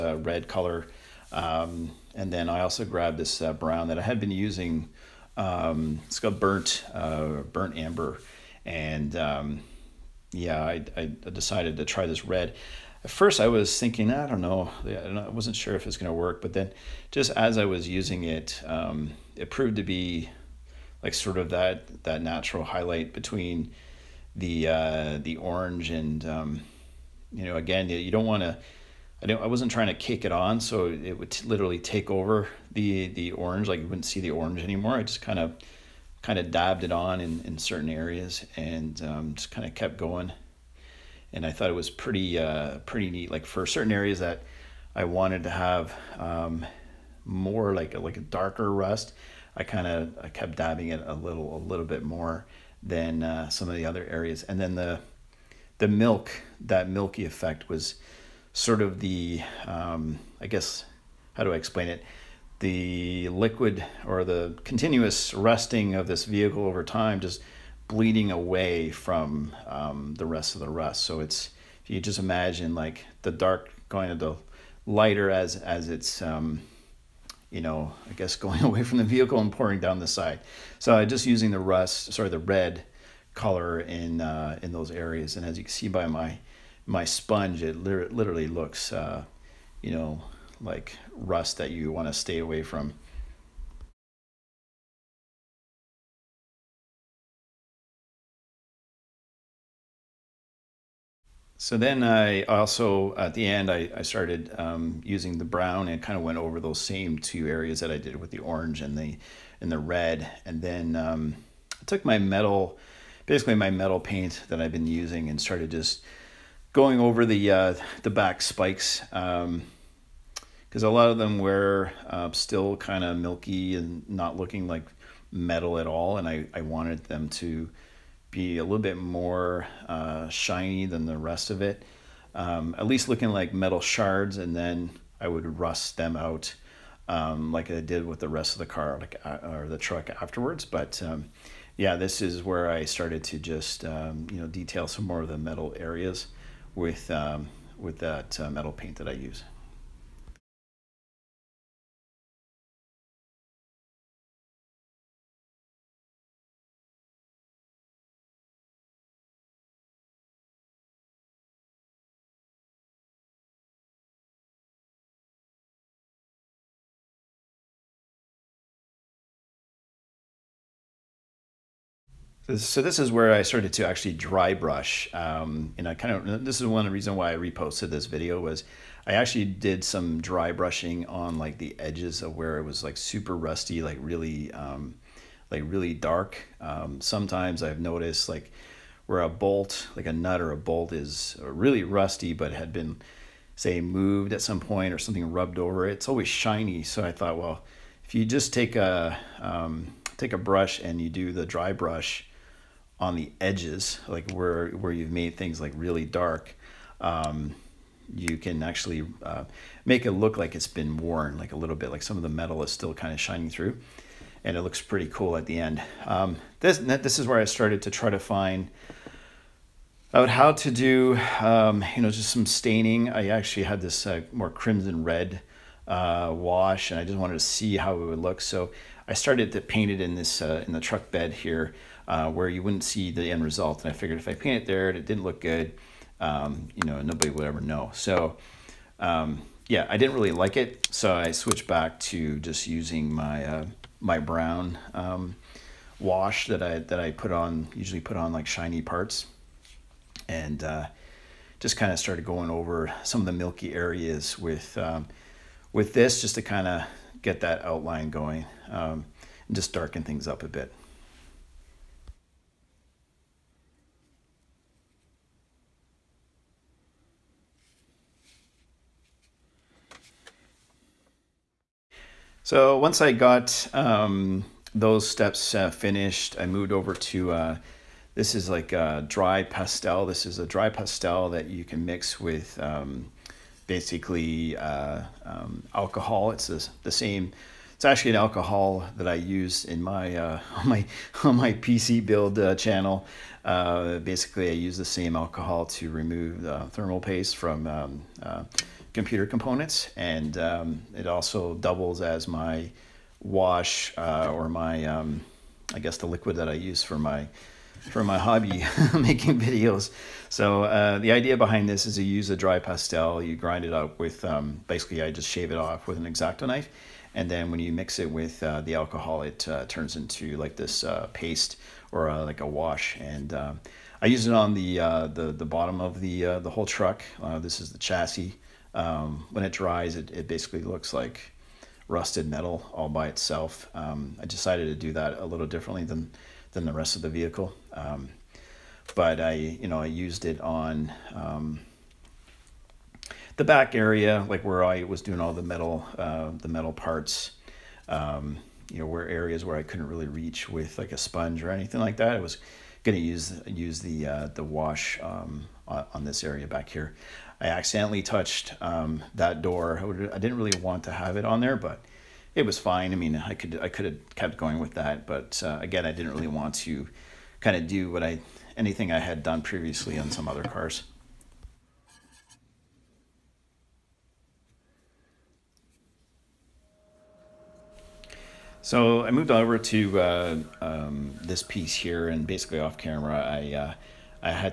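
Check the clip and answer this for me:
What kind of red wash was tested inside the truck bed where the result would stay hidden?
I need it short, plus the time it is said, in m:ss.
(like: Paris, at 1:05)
crimson red, at 3:44.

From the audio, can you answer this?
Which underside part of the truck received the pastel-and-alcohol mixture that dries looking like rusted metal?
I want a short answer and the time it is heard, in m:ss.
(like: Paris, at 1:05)
the chassis, at 5:27.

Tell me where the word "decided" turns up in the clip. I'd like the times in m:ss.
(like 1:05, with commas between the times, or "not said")
0:11, 5:34.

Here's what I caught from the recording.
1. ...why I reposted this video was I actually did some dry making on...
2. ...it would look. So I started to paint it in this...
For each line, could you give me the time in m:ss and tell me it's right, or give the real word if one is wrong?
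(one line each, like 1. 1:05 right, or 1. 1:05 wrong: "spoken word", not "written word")
1. 2:57 wrong: "brushing", not "making"
2. 3:47 right.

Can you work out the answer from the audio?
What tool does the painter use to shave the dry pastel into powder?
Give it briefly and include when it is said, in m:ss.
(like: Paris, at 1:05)
X-Acto knife, at 5:16.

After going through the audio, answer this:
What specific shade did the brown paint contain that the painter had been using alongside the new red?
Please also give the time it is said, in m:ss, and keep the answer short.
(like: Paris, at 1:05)
burnt amber, at 0:07.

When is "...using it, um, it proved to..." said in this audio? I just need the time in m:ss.
0:17.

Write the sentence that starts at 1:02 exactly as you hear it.
the liquid or the continuous rusting of this vehicle over time just bleeding away from um, the rest of the rust.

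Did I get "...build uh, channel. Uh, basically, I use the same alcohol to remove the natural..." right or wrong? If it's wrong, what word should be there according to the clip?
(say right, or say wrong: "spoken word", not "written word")
wrong: "thermal", not "natural".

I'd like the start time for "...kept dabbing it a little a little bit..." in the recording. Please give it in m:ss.
0:50.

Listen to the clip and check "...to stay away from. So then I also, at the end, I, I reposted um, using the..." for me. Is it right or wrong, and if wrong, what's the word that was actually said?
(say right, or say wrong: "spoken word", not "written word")
wrong: "started", not "reposted".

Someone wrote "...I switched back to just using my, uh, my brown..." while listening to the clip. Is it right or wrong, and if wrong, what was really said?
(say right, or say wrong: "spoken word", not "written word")
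right.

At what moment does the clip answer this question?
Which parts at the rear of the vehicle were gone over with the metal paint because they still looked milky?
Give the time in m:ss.
1:58.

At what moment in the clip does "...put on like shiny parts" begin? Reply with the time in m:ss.
4:07.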